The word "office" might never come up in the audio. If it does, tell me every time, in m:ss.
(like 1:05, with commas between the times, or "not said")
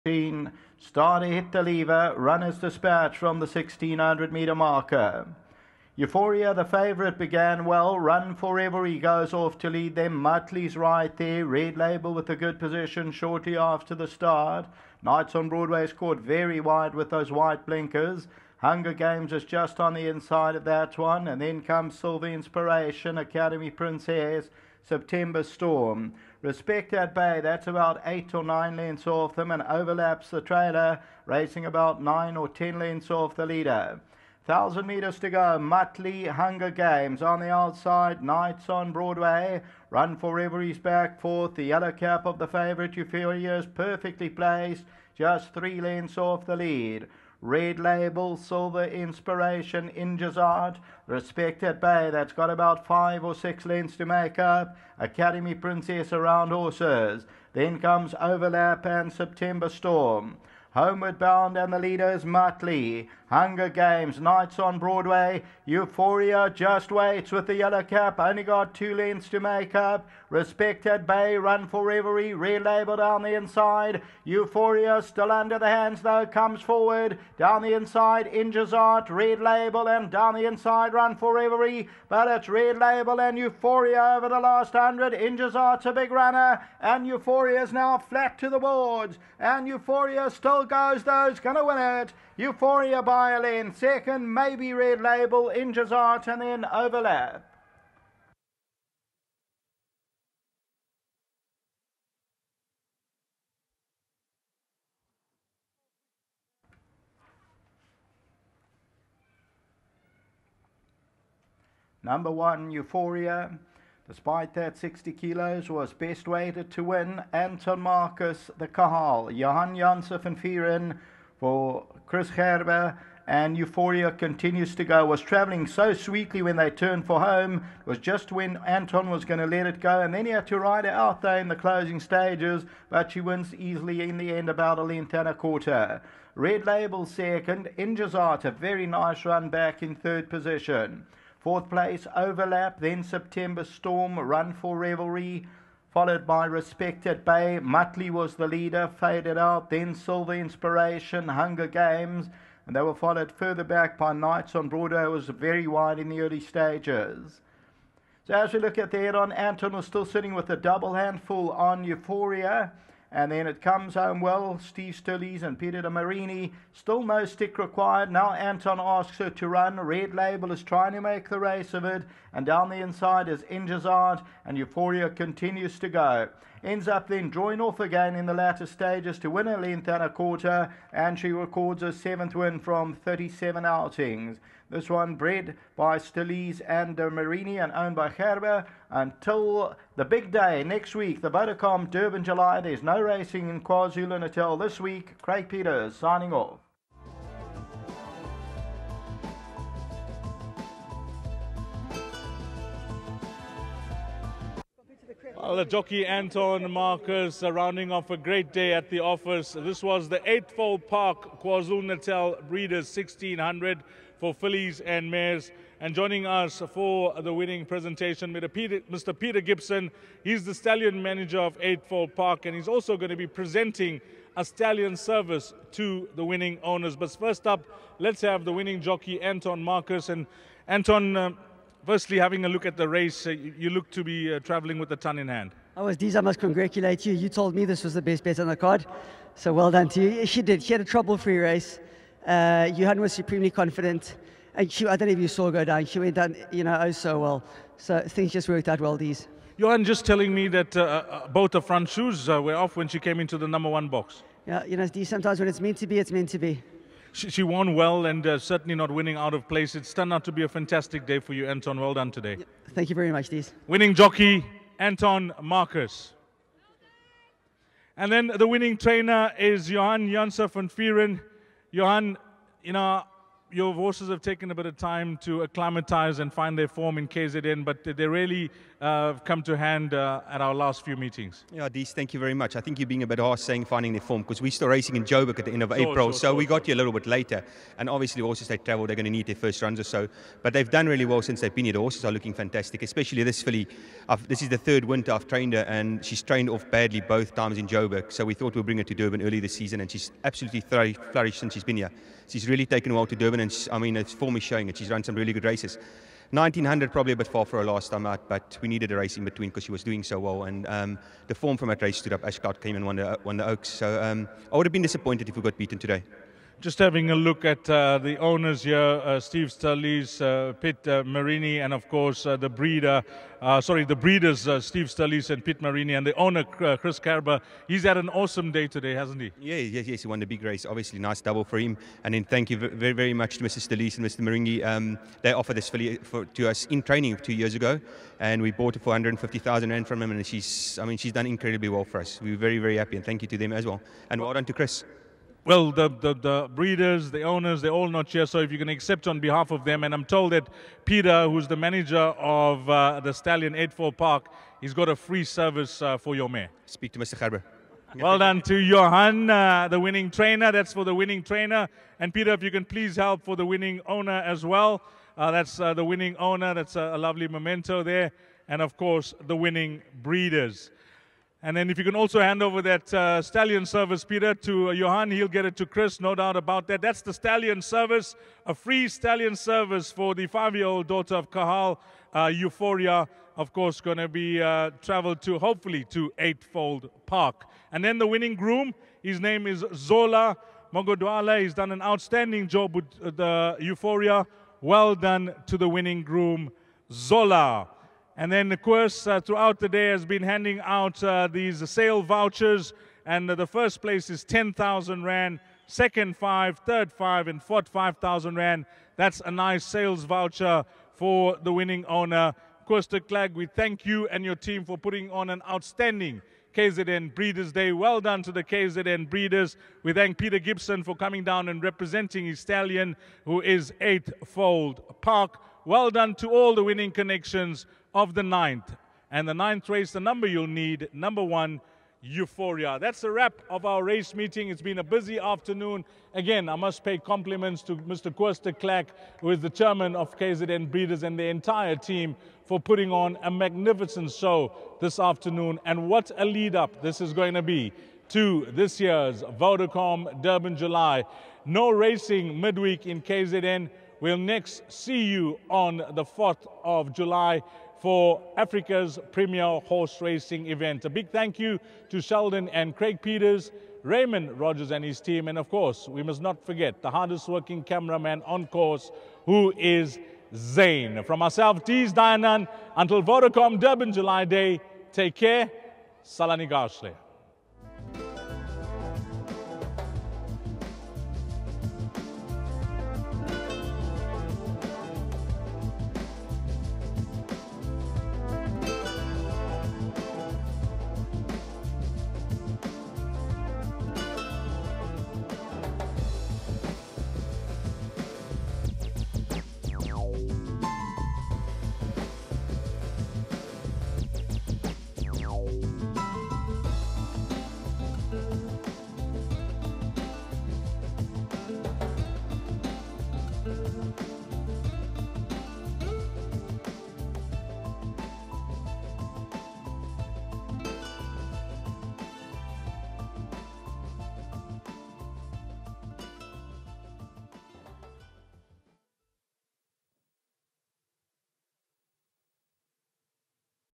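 3:29.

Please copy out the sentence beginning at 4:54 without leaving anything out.
I've, this is the third winter I've trained her, and she's trained off badly both times in Joburg.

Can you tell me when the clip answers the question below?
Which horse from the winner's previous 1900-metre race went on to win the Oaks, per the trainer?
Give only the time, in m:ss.
5:12.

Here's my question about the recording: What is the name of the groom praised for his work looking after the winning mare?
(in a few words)
Zola Mogodwale.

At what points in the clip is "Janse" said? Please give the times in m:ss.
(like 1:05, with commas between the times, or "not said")
1:59, 4:30.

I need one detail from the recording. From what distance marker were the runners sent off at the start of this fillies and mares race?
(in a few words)
1600 meters.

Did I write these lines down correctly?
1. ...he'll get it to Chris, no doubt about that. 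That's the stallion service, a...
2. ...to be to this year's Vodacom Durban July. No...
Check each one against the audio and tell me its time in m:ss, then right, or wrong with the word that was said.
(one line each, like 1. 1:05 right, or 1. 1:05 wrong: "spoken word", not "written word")
1. 6:15 right
2. 7:27 right.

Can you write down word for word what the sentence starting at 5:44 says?
And well done to Chris well, the, the, the, breeders, the owners, they're all not here.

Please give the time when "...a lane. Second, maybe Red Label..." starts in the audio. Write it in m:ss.
1:33.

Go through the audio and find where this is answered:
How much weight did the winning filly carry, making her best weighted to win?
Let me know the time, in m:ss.
1:54.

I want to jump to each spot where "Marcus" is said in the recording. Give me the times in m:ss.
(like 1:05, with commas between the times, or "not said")
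1:57, 3:26, 3:49, 4:25.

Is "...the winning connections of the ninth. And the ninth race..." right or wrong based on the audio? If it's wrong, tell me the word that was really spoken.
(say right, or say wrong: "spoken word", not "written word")
right.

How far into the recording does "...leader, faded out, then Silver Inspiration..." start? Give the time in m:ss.
2:28.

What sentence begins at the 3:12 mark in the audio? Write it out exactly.
There's no racing in KwaZulu Natal this week.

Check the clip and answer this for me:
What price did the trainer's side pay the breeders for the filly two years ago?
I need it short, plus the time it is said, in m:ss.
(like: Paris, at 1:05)
150,000 rand, at 5:38.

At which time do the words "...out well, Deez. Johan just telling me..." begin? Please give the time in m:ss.
4:08.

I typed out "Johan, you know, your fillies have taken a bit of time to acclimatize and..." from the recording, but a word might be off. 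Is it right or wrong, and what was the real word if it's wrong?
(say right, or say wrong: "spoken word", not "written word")
wrong: "horses", not "fillies".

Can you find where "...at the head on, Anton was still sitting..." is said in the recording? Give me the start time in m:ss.
2:38.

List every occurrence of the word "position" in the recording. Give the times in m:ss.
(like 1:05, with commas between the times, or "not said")
0:12, 2:20.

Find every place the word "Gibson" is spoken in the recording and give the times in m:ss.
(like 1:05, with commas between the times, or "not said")
3:39, 7:00.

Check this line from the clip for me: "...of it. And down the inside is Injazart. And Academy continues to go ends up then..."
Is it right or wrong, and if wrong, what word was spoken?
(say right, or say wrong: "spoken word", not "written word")
wrong: "Euphoria", not "Academy".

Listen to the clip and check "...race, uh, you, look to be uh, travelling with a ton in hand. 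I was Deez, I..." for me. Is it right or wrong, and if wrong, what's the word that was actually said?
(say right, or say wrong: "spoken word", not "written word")
right.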